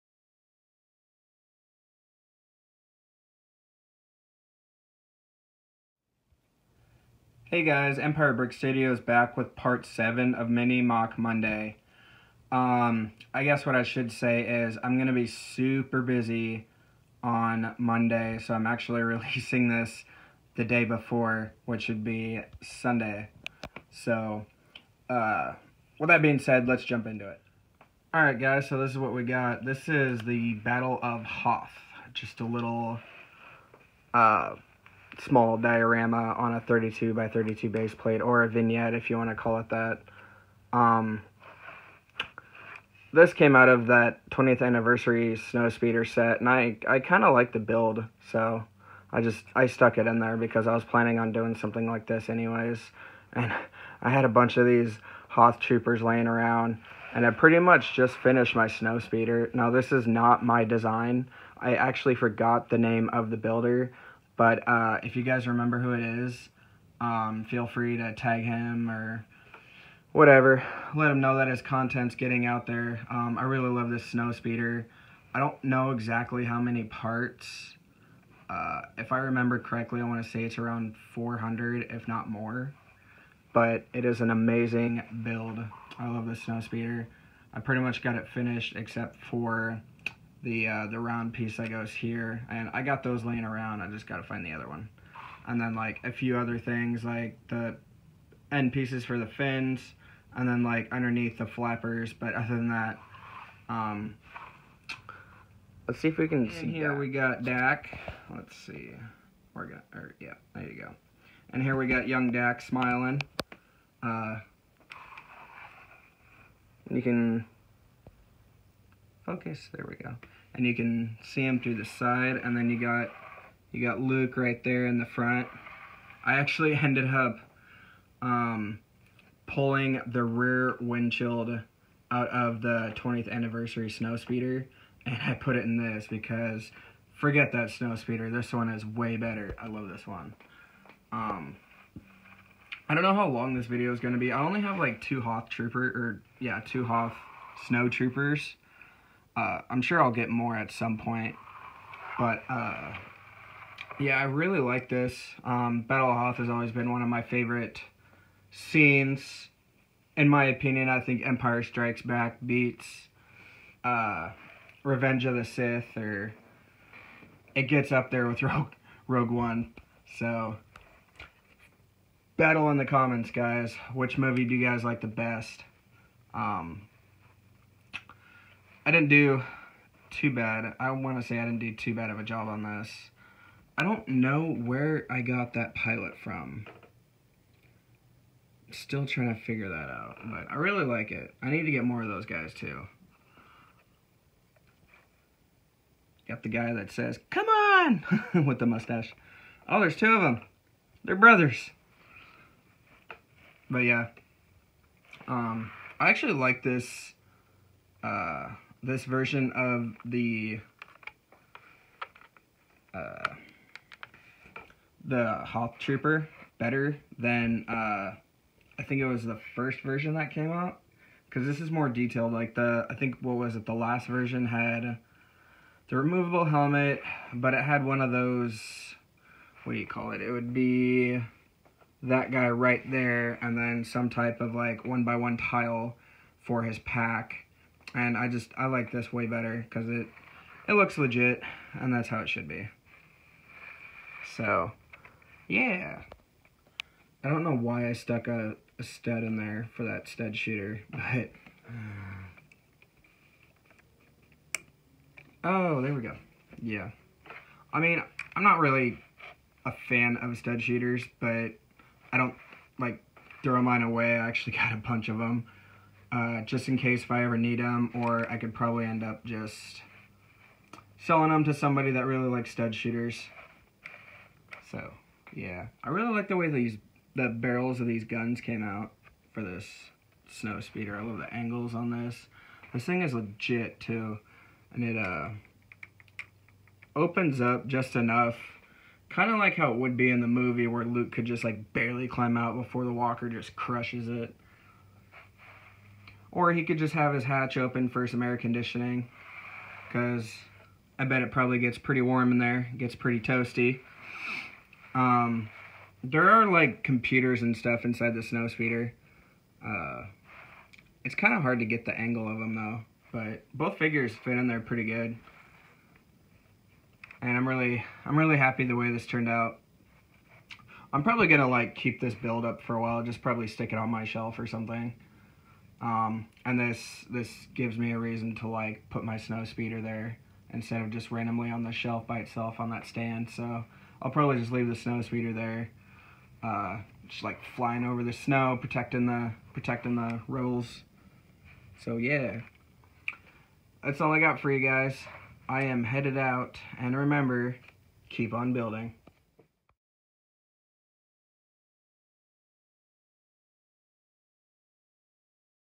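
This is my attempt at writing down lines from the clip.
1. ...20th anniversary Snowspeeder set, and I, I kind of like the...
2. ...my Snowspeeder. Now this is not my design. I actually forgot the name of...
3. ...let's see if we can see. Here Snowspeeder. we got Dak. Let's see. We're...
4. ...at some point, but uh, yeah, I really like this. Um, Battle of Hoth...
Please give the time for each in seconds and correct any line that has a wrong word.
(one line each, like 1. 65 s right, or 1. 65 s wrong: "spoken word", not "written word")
1. 44 s right
2. 58 s right
3. 105 s wrong: "Dak", not "Snowspeeder"
4. 150 s right.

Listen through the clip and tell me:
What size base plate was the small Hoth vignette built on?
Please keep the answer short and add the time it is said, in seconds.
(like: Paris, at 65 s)
32 by 32, at 36 s.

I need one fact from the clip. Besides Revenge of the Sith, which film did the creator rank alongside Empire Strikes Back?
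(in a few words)
Rogue One.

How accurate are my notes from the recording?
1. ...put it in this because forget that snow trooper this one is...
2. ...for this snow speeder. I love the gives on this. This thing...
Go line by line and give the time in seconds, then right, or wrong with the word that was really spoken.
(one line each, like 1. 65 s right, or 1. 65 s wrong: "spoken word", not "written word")
1. 135 s wrong: "speeder", not "trooper"
2. 279 s wrong: "angles", not "gives".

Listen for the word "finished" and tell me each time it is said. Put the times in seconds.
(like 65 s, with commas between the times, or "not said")
58 s, 88 s.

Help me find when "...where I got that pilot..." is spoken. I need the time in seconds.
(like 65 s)
184 s.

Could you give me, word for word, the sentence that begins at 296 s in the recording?
Or he could just have his hatch open for some air conditioning because I bet it probably gets pretty warm in there.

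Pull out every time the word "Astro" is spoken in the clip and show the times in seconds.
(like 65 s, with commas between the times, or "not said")
not said.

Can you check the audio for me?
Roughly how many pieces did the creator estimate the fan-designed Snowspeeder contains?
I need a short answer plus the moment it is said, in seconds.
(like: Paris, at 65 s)
400, at 81 s.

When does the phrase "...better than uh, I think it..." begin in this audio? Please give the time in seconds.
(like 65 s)
216 s.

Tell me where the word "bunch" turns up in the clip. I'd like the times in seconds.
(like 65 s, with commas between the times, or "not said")
54 s, 264 s.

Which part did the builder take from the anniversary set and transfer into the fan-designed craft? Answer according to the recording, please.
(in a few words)
rear windshield.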